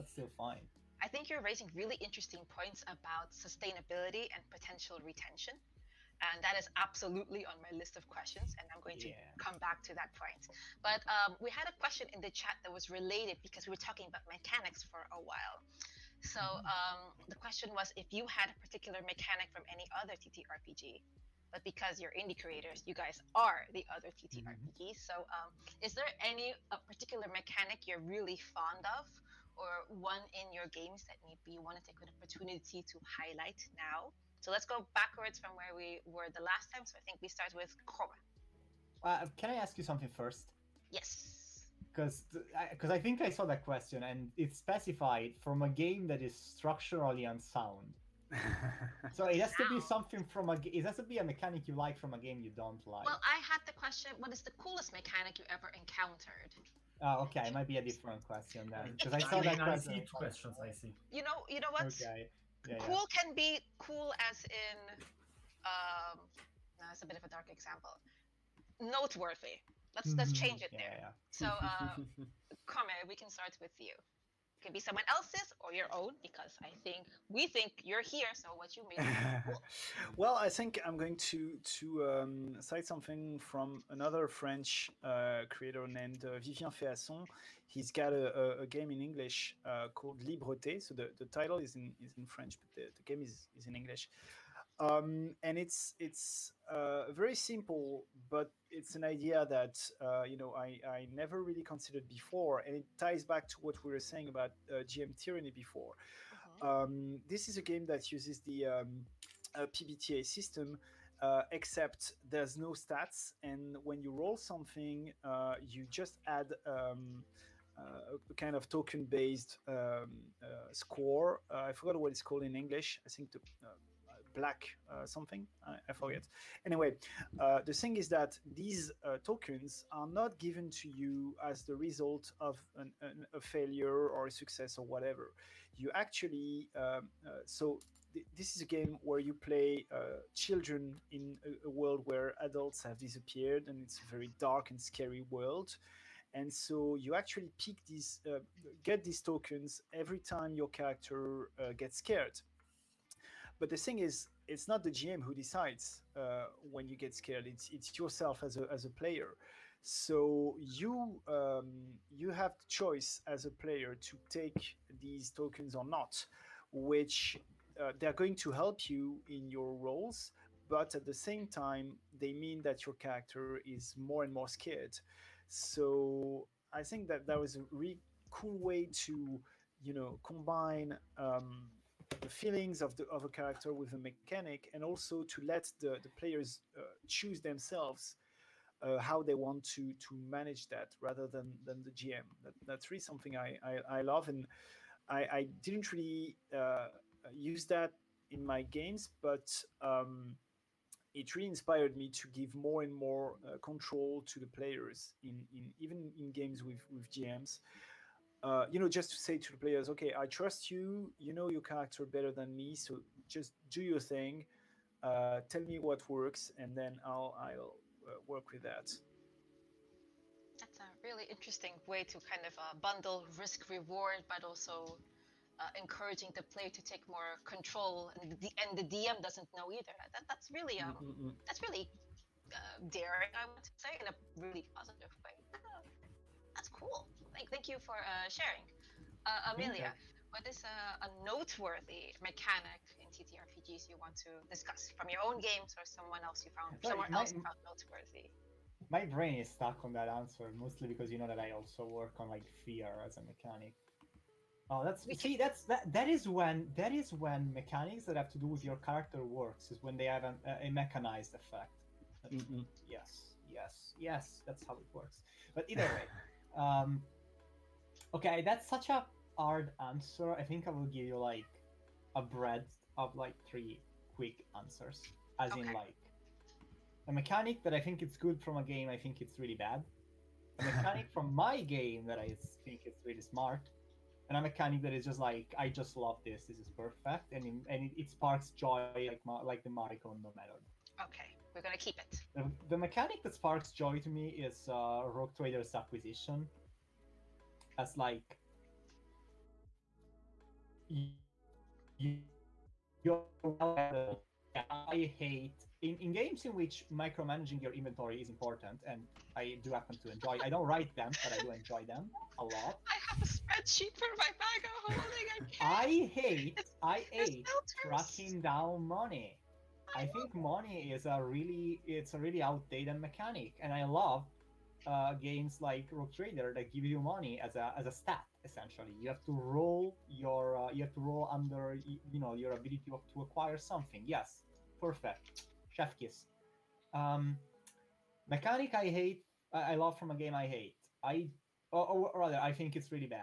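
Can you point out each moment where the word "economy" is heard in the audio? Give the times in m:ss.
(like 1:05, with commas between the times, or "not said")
not said.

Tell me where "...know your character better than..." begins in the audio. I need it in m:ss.
3:31.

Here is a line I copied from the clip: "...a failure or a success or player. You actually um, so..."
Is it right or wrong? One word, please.
wrong.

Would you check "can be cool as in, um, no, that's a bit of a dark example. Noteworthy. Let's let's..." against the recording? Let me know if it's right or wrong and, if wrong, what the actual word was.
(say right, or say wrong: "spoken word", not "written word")
right.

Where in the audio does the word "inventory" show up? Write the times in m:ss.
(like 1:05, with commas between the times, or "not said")
5:07.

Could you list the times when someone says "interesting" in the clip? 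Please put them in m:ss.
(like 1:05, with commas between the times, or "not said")
0:01, 3:41.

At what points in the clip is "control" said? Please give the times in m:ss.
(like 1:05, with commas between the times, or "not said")
3:23, 3:47.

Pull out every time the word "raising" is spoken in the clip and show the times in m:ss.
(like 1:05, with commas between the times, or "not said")
0:01.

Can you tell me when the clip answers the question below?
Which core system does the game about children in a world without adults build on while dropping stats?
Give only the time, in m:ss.
1:49.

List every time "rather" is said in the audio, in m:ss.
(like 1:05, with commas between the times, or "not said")
3:10, 5:42.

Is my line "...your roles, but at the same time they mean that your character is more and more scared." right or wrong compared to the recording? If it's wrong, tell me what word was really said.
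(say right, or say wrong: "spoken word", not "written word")
right.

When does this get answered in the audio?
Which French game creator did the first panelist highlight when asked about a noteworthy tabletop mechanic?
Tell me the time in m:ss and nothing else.
1:26.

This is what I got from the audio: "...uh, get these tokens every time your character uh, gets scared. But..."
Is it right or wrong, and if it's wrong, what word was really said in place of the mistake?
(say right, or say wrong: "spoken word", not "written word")
right.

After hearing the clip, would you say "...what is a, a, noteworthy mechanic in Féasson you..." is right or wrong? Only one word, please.
wrong.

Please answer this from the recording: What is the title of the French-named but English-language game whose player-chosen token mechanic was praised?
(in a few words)
Libreté.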